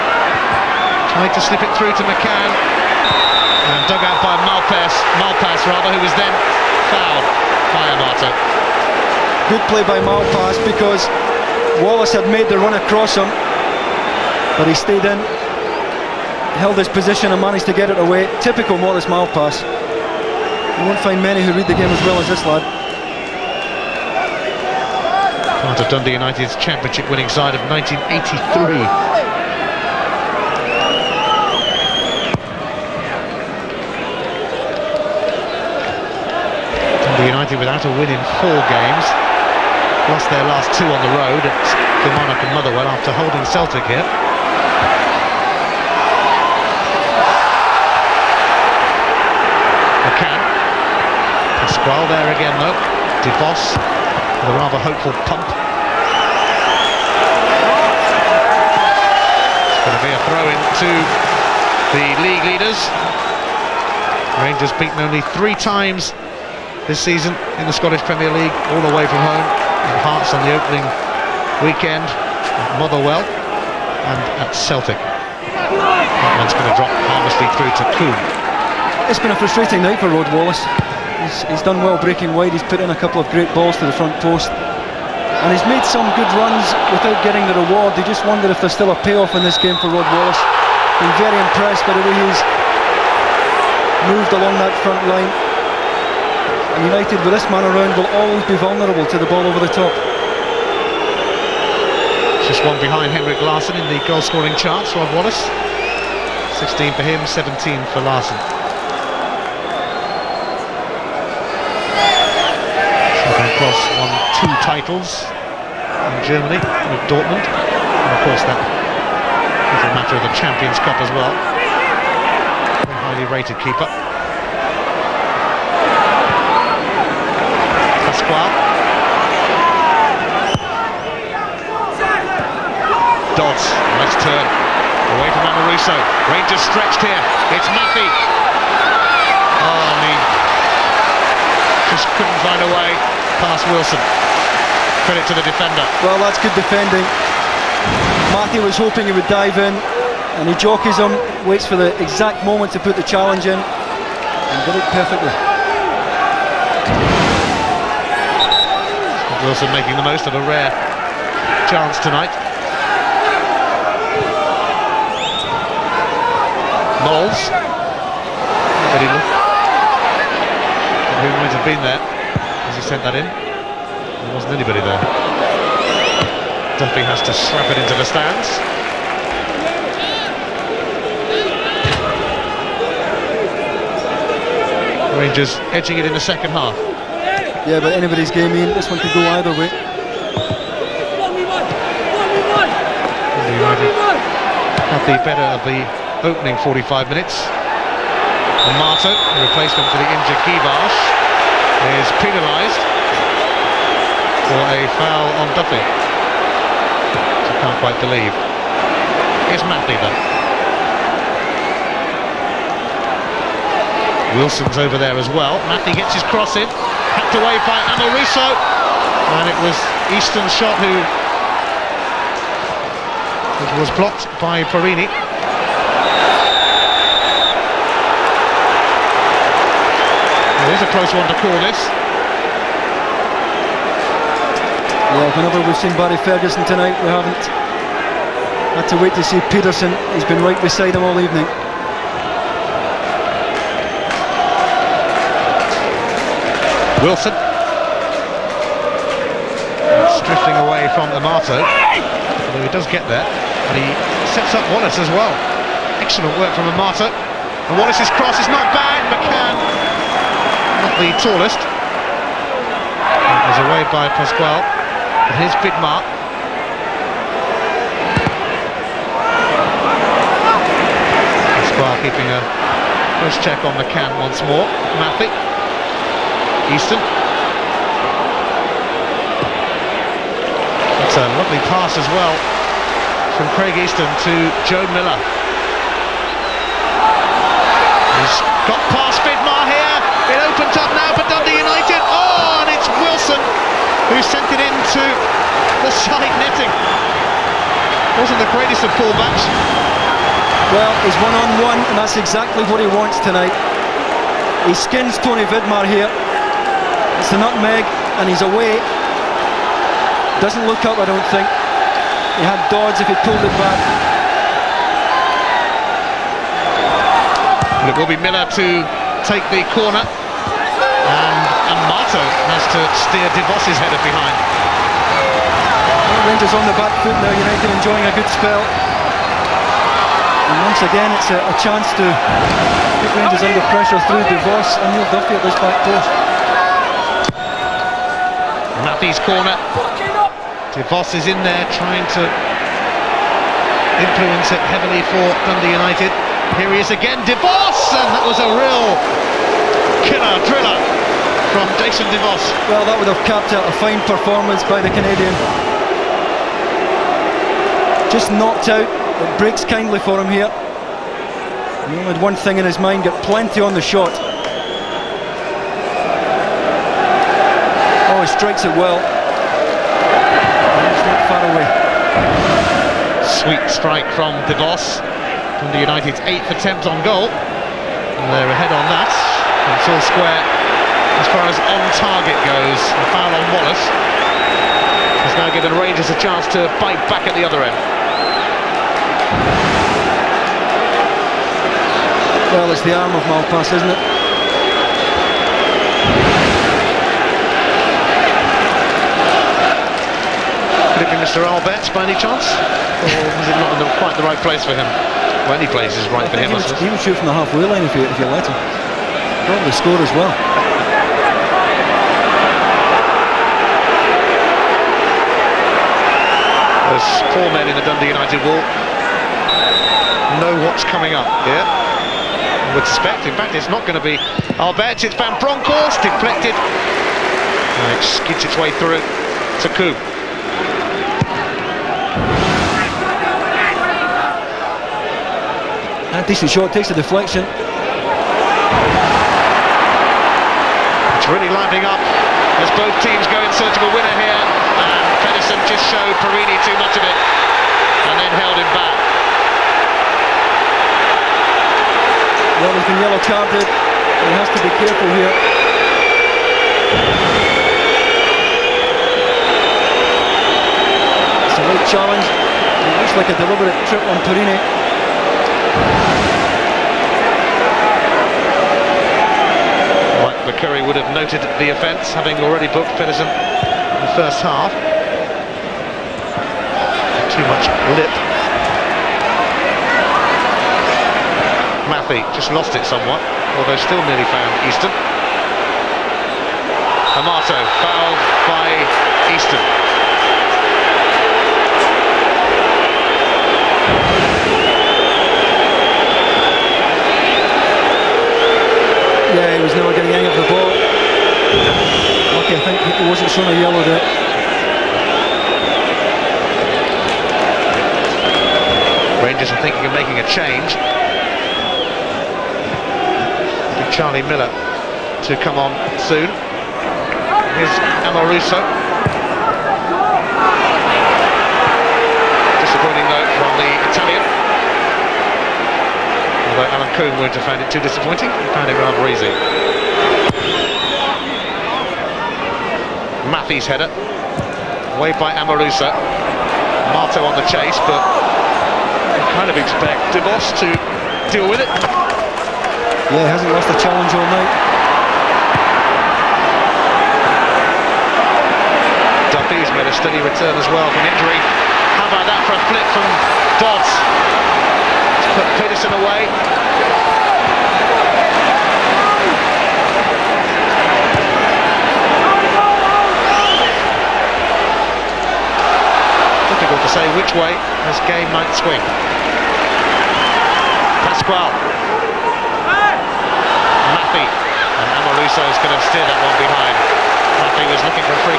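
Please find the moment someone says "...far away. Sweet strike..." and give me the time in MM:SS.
06:11.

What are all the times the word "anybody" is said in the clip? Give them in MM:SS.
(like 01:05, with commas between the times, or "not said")
02:54, 03:07.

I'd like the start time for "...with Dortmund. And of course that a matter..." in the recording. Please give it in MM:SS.
01:56.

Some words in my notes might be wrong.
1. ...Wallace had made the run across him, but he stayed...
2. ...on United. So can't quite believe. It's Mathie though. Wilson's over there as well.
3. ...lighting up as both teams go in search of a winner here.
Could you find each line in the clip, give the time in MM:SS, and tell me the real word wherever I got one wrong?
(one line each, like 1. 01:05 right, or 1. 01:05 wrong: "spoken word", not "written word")
1. 00:11 right
2. 03:25 wrong: "Duffy", not "United"
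3. 07:21 right.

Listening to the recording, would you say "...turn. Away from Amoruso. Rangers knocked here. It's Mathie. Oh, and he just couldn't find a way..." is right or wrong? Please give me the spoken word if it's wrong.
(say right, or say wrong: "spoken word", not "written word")
wrong: "stretched", not "knocked".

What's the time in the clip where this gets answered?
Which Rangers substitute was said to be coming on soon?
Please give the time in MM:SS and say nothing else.
08:33.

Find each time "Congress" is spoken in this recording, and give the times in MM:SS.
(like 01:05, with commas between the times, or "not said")
not said.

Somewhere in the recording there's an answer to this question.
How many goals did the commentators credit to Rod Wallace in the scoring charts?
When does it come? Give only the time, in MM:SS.
01:46.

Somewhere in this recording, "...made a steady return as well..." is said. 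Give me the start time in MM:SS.
09:09.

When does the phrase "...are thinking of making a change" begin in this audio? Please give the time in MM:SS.
08:29.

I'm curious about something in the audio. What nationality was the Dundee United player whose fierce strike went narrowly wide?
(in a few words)
Canadian.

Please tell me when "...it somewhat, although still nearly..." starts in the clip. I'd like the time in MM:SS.
08:02.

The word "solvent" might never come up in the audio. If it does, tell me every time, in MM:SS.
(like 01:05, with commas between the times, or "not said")
not said.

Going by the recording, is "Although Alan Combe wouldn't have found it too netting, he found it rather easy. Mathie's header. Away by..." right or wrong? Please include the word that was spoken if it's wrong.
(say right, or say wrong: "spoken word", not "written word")
wrong: "disappointing", not "netting".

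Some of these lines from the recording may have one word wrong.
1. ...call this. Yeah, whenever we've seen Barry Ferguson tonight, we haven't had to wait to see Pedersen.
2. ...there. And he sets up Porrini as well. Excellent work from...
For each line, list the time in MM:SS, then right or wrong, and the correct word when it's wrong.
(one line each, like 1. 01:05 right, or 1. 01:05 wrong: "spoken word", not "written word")
1. 03:51 right
2. 04:13 wrong: "Wallace", not "Porrini".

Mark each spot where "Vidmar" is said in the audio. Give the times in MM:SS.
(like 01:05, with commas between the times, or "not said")
04:25, 04:49, 05:05.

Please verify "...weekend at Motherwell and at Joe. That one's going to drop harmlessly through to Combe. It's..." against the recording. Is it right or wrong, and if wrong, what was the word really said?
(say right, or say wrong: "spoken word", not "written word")
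wrong: "Celtic", not "Joe".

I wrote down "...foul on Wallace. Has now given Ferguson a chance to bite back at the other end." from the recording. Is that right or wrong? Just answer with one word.
wrong.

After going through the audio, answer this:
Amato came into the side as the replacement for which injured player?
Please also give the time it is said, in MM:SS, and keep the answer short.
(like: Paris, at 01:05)
Guivarc'h, at 03:20.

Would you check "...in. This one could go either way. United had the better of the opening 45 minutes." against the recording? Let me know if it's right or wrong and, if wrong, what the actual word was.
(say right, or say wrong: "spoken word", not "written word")
right.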